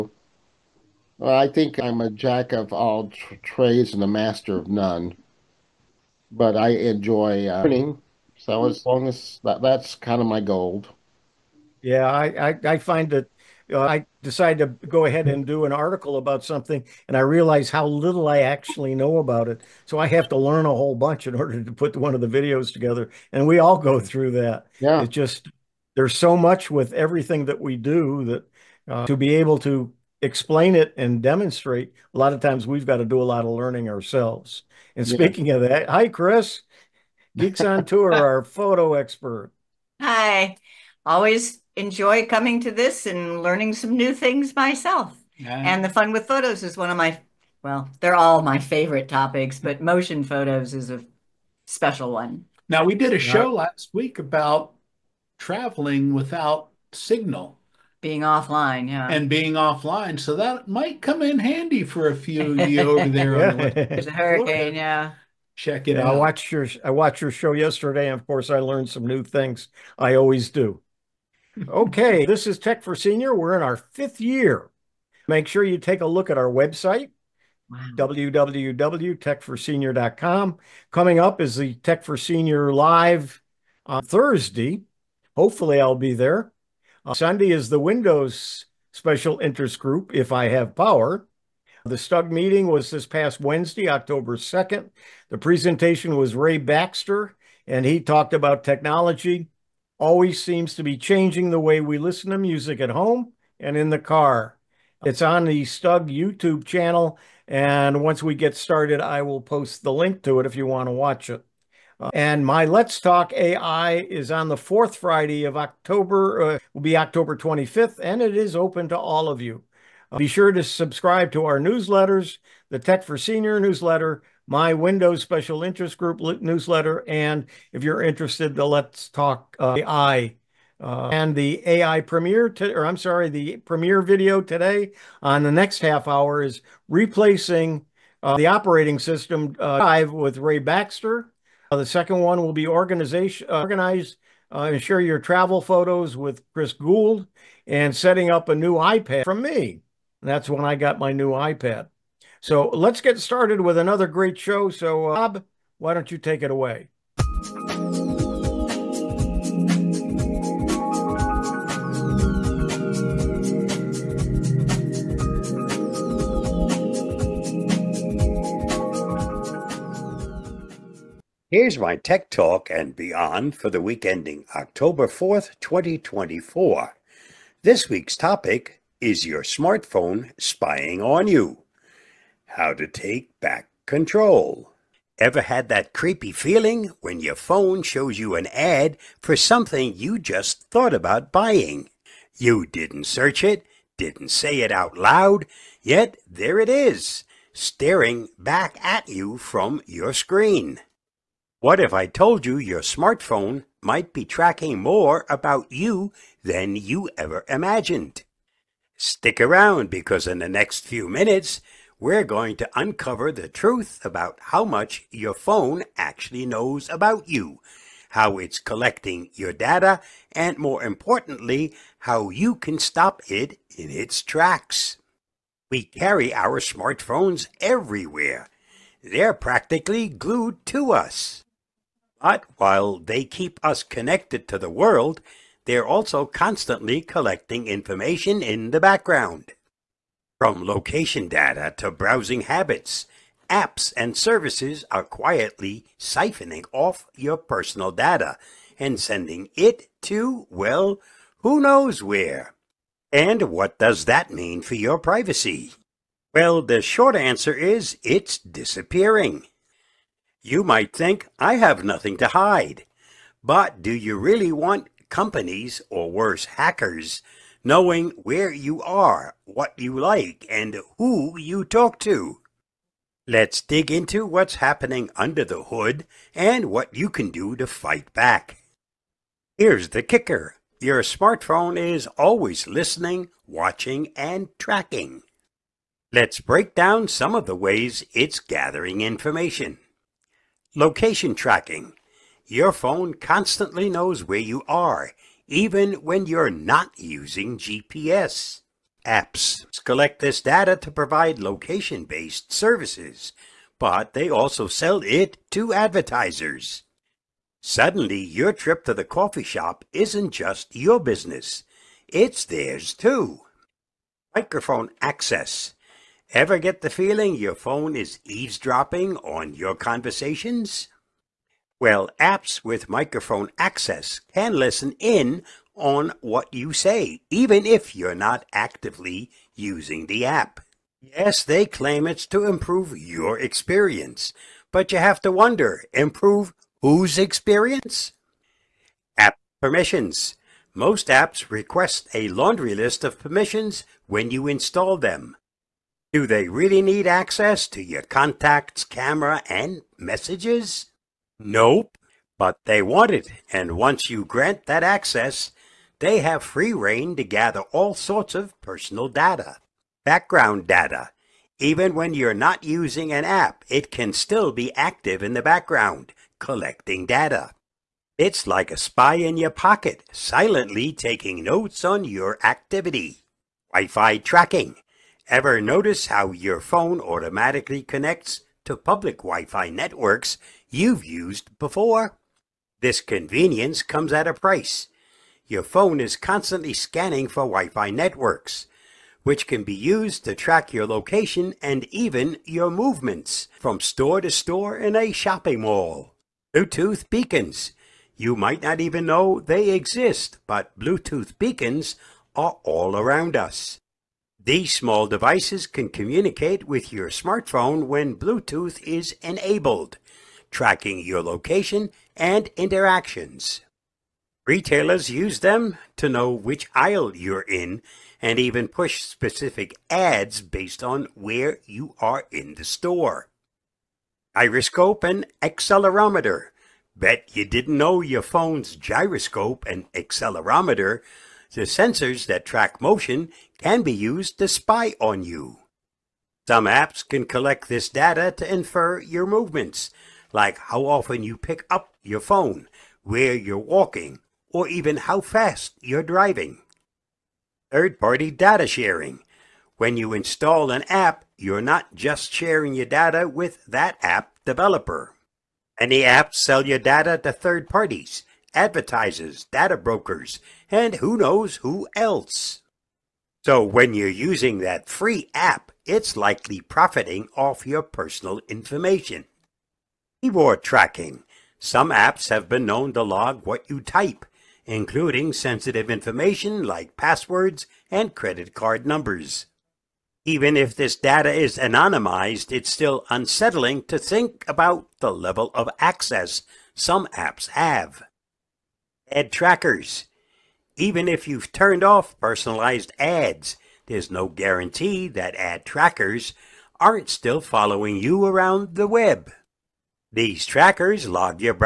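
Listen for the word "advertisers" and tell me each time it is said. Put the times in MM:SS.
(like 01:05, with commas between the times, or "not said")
05:05, 07:38.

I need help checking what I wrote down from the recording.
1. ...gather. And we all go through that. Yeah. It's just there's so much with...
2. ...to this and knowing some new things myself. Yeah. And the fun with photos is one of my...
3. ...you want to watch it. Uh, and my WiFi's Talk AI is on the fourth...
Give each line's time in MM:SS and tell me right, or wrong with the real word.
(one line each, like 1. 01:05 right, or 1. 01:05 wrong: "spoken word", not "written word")
1. 00:22 wrong: "together", not "gather"
2. 00:42 wrong: "learning", not "knowing"
3. 01:50 wrong: "Let", not "WiFi".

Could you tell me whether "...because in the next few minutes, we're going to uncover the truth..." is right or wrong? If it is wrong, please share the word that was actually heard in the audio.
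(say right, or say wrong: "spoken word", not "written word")
right.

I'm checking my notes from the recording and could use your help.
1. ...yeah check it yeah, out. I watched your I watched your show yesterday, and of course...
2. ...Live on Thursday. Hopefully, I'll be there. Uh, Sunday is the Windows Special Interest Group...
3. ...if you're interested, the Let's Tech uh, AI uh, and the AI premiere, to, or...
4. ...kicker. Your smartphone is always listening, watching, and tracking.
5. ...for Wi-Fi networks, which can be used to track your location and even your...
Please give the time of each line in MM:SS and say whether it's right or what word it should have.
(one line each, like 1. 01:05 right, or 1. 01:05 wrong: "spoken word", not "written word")
1. 01:04 right
2. 01:22 right
3. 02:07 wrong: "Talk", not "Tech"
4. 04:40 right
5. 06:27 right.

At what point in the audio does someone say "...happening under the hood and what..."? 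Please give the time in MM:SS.
04:34.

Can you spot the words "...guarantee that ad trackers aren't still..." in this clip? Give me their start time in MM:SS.
08:14.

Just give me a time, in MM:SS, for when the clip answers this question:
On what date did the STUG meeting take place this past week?
01:33.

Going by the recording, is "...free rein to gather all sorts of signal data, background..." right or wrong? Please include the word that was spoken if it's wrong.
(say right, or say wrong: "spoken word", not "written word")
wrong: "personal", not "signal".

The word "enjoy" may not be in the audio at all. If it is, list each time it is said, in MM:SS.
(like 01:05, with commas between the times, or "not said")
00:06, 00:41.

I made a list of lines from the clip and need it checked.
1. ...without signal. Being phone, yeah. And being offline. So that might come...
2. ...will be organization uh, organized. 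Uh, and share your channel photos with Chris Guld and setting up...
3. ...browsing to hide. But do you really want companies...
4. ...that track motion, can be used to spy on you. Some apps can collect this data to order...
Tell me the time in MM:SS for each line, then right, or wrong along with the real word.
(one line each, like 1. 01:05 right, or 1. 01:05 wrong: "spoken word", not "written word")
1. 00:56 wrong: "offline", not "phone"
2. 02:22 wrong: "travel", not "channel"
3. 04:21 wrong: "nothing", not "browsing"
4. 07:12 wrong: "infer", not "order".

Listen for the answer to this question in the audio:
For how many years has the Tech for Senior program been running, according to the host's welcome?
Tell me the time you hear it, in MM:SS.
01:13.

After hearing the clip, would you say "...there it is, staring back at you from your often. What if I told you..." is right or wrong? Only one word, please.
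wrong.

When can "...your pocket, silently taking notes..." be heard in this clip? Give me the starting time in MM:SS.
06:09.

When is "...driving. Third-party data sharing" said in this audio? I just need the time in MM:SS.
07:26.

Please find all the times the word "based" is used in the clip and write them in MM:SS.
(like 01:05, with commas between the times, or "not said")
05:01, 07:00.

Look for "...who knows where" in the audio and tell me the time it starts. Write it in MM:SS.
04:11.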